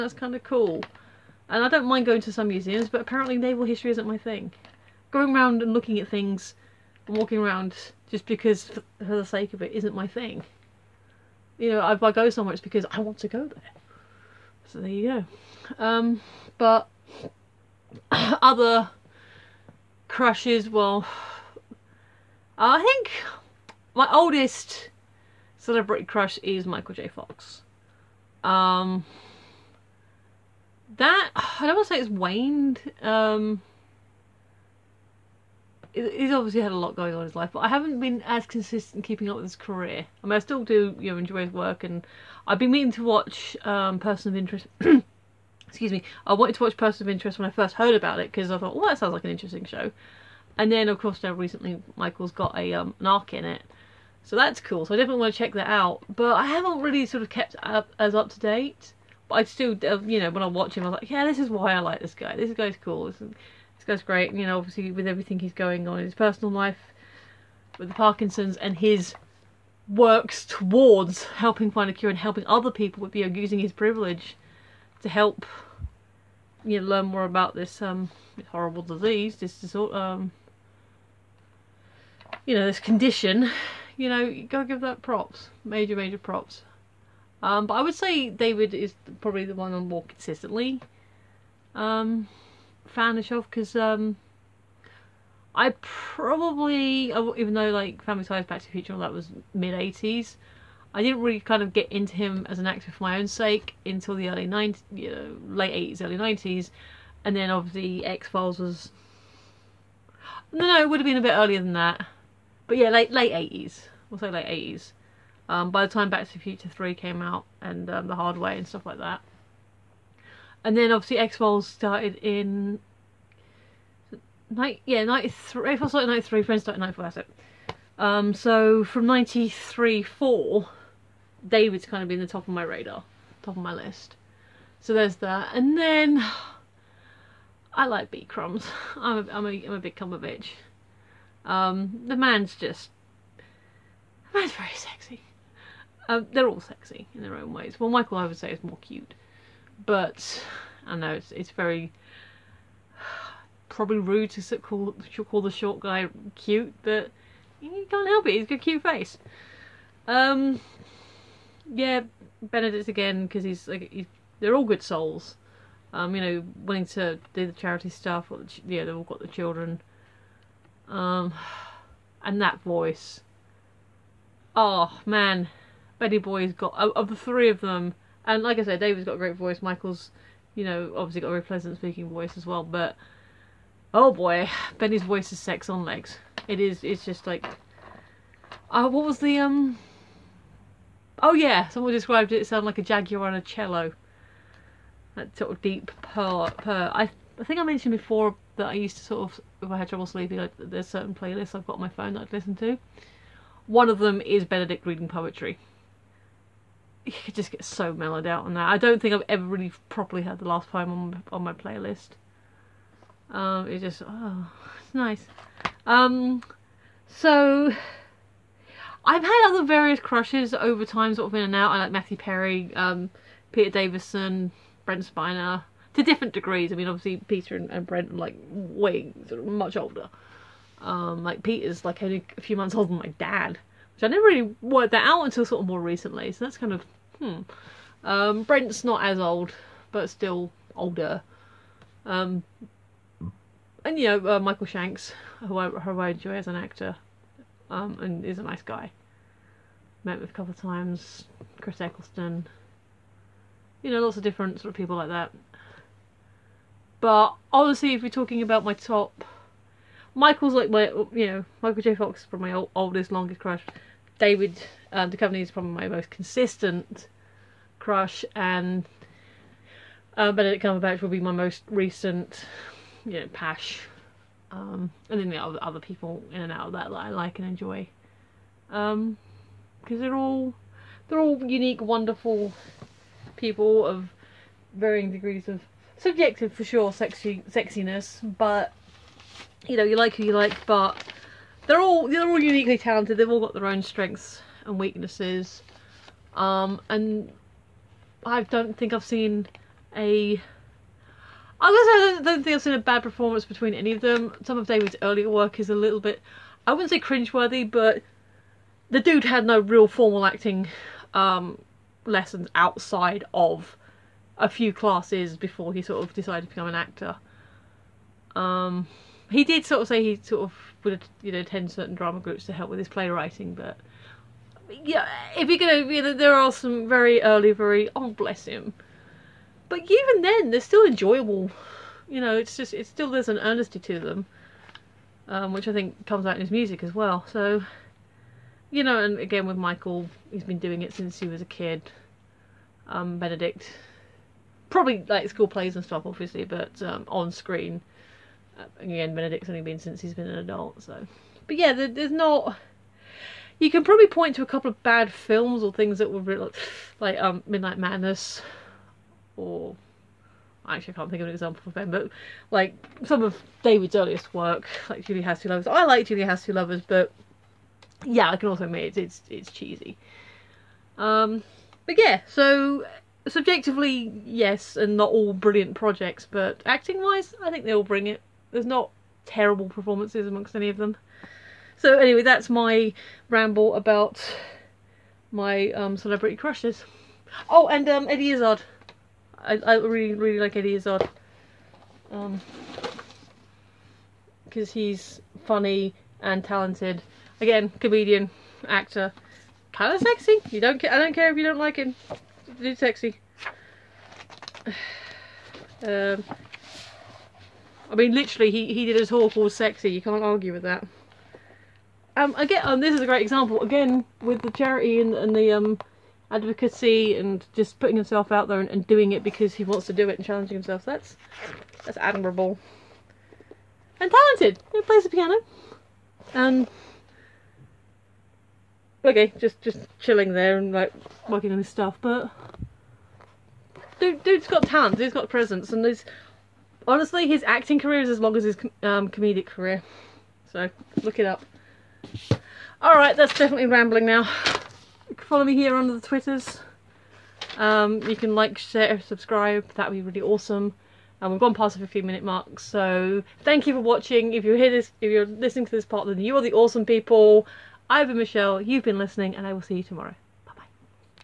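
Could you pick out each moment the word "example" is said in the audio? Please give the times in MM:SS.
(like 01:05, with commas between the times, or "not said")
06:01, 06:53.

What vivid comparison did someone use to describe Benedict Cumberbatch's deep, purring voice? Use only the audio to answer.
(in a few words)
a jaguar on a cello.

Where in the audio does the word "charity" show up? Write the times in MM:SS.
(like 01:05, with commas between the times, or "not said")
02:47, 06:54.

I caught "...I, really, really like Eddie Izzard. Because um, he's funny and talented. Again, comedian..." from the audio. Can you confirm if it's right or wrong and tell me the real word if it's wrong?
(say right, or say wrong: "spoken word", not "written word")
right.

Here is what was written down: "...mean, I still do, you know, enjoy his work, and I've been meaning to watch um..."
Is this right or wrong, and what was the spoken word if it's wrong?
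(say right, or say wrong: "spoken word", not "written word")
right.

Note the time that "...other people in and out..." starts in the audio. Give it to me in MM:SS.
04:35.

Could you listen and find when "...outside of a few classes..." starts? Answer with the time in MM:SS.
05:12.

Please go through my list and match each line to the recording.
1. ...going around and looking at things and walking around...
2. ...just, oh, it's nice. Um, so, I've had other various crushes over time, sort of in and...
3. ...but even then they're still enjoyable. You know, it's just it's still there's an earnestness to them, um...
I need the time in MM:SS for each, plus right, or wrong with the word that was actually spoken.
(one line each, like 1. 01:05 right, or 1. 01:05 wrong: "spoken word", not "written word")
1. 00:05 right
2. 03:33 right
3. 05:29 right.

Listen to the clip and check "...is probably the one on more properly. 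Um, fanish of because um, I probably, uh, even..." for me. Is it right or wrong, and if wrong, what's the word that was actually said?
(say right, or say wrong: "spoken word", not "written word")
wrong: "consistently", not "properly".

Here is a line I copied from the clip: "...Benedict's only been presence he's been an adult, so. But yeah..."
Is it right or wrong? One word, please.
wrong.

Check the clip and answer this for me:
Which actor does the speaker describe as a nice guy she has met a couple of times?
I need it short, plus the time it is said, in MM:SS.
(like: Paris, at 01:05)
Michael Shanks, at 04:04.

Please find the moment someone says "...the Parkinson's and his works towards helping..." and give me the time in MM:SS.
01:07.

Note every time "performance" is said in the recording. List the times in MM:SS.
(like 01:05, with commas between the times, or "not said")
05:03, 06:19.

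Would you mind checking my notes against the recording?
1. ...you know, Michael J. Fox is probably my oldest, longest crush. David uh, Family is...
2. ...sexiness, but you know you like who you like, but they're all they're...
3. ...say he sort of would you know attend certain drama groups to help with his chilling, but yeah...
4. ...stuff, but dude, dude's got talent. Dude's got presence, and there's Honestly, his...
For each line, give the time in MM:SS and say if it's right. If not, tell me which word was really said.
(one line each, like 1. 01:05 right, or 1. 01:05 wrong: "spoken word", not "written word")
1. 04:21 wrong: "Duchovny", not "Family"
2. 04:47 right
3. 05:19 wrong: "playwriting", not "chilling"
4. 07:11 right.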